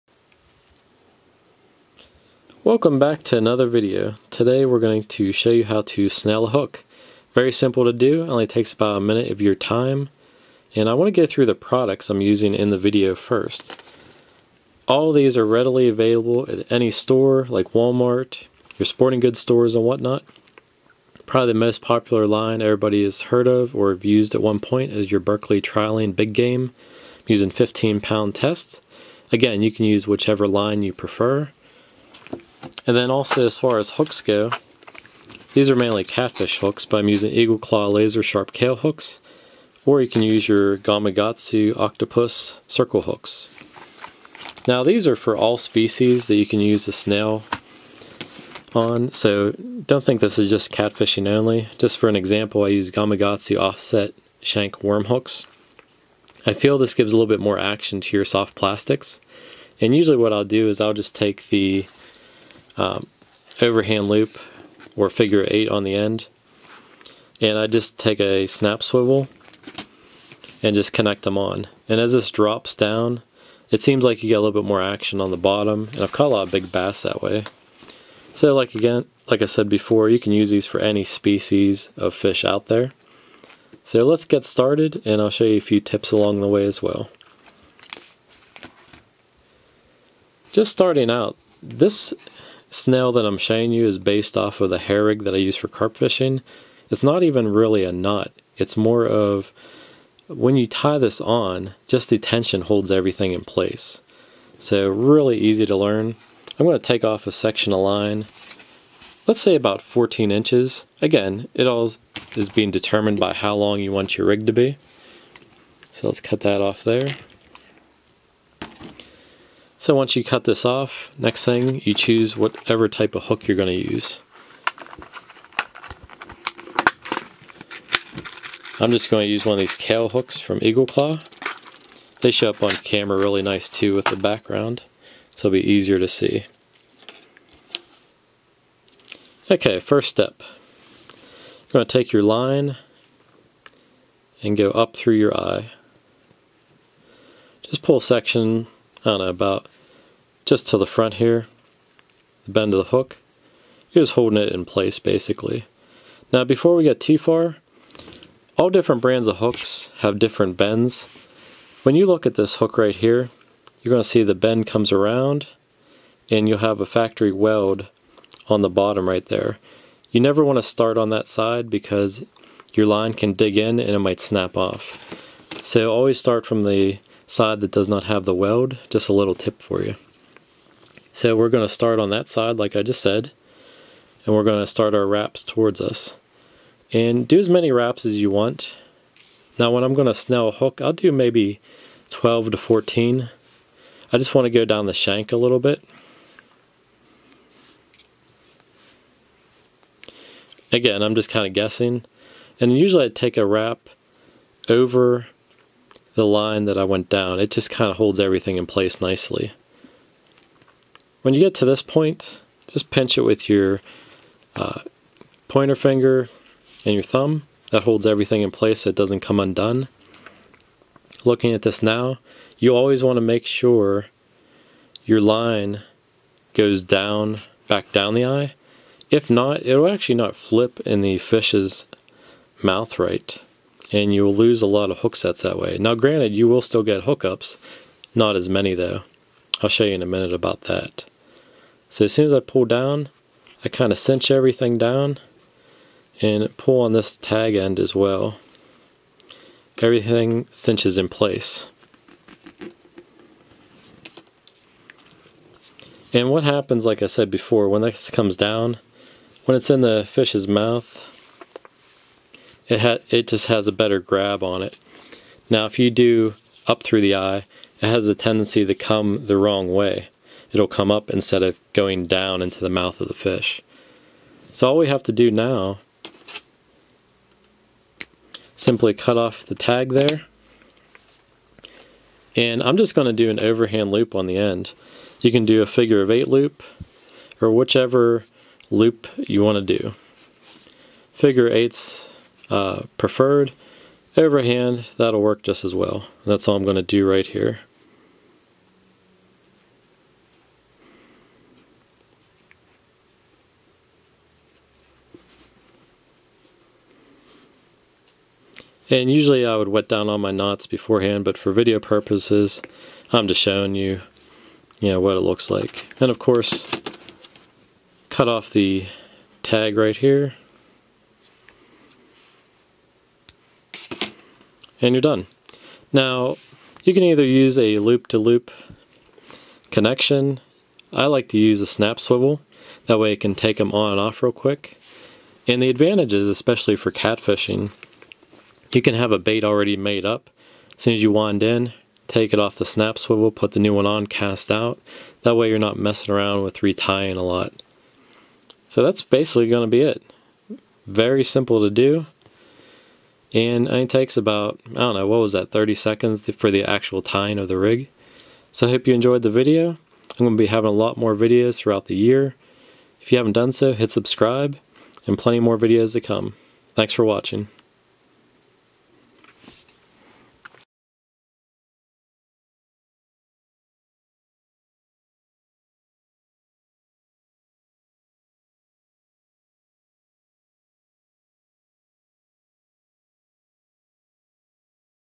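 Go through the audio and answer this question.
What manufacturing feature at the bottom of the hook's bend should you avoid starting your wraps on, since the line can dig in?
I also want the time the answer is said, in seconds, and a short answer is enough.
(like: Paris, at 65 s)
Factory weld, at 166 s.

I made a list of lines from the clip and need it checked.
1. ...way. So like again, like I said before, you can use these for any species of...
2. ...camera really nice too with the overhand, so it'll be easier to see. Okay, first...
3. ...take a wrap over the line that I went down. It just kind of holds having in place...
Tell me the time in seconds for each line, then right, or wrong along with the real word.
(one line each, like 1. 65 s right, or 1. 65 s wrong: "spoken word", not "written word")
1. 77 s right
2. 132 s wrong: "background", not "overhand"
3. 203 s wrong: "everything", not "having".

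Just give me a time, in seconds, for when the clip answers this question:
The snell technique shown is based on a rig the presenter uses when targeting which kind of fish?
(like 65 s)
95 s.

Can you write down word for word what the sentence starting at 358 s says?
So I hope you enjoyed the video.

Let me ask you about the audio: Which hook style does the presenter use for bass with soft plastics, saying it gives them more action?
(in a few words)
Gamakatsu Offset Shank Worm hooks.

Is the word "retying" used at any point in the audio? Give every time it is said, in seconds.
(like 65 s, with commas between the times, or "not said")
346 s.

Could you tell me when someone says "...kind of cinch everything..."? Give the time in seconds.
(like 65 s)
243 s.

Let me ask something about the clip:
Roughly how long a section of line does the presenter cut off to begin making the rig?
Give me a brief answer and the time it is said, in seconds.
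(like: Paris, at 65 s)
14 inches, at 109 s.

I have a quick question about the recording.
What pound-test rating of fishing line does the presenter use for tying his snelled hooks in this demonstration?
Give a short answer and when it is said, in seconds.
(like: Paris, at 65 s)
15, at 27 s.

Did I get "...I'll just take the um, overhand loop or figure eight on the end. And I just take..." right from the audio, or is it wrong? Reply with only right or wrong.
right.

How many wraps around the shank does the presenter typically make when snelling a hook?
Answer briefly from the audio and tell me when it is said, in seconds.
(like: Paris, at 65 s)
12 to 14, at 192 s.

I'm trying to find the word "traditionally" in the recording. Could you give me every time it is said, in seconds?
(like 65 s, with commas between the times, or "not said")
not said.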